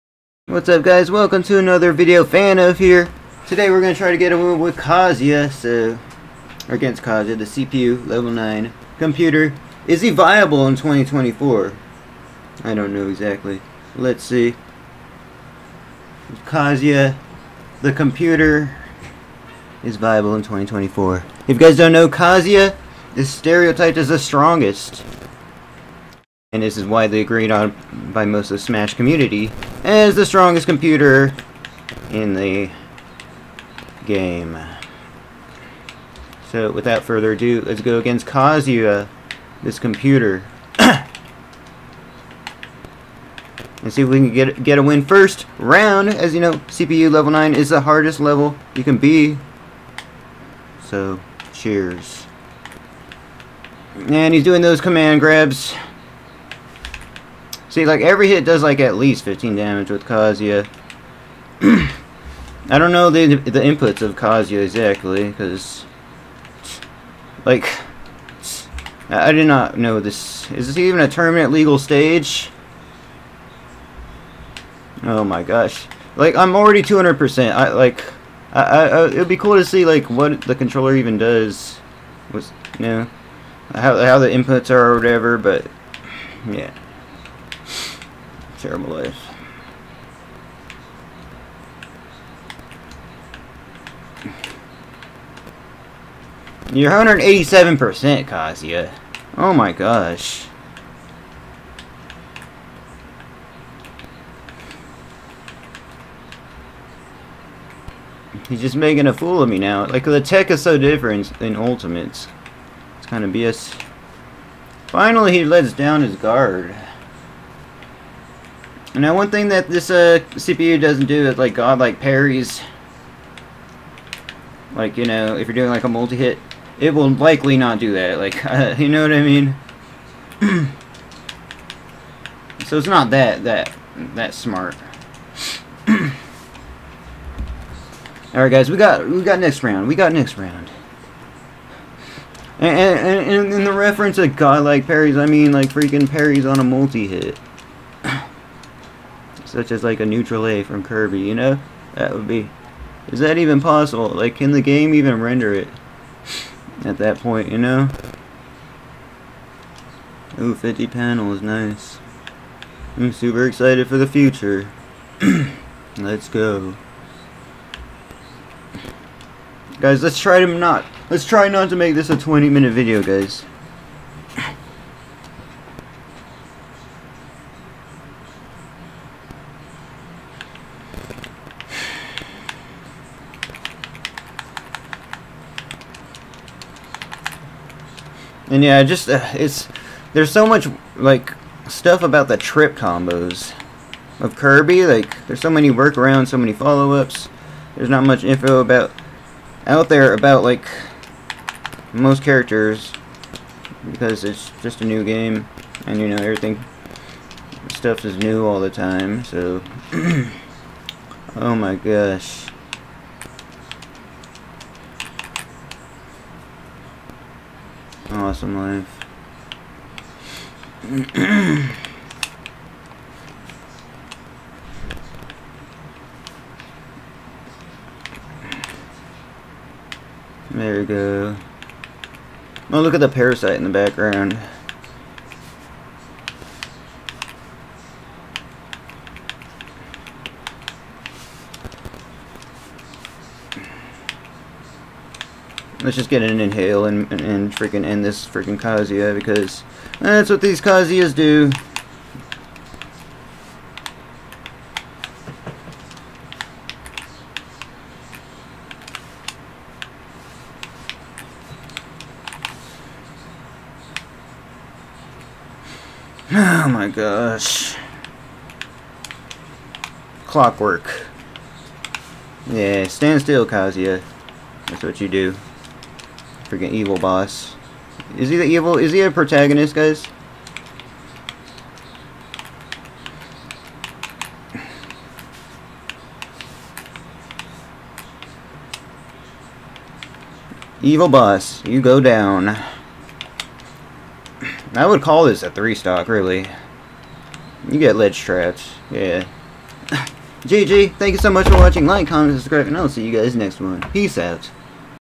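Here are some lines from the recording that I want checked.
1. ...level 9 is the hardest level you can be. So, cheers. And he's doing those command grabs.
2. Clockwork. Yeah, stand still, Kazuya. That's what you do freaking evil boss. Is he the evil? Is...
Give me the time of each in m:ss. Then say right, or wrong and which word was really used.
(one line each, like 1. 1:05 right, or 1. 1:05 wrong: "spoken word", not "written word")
1. 0:47 right
2. 4:30 right.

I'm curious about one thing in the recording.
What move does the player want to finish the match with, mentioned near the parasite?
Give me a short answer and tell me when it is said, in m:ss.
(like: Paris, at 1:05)
Inhale, at 4:06.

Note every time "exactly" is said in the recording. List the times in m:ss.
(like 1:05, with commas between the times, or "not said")
0:13, 1:04.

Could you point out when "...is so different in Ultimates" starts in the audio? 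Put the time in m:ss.
1:50.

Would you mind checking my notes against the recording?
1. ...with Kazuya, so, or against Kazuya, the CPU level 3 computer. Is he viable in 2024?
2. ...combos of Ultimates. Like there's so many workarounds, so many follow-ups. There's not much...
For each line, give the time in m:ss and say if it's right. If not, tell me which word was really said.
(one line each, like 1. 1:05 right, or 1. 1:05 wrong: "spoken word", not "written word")
1. 0:04 wrong: "9", not "3"
2. 3:12 wrong: "Kirby", not "Ultimates".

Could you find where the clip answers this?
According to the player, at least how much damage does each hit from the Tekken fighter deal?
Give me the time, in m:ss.
0:59.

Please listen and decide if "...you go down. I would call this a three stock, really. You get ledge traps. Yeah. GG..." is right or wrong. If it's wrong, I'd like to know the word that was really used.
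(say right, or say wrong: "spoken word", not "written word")
right.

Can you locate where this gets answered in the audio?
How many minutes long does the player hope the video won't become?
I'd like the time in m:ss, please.
2:52.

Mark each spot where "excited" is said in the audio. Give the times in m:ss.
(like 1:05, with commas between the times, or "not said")
2:43.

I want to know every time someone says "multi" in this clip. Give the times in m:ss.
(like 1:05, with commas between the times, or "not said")
2:05, 2:26.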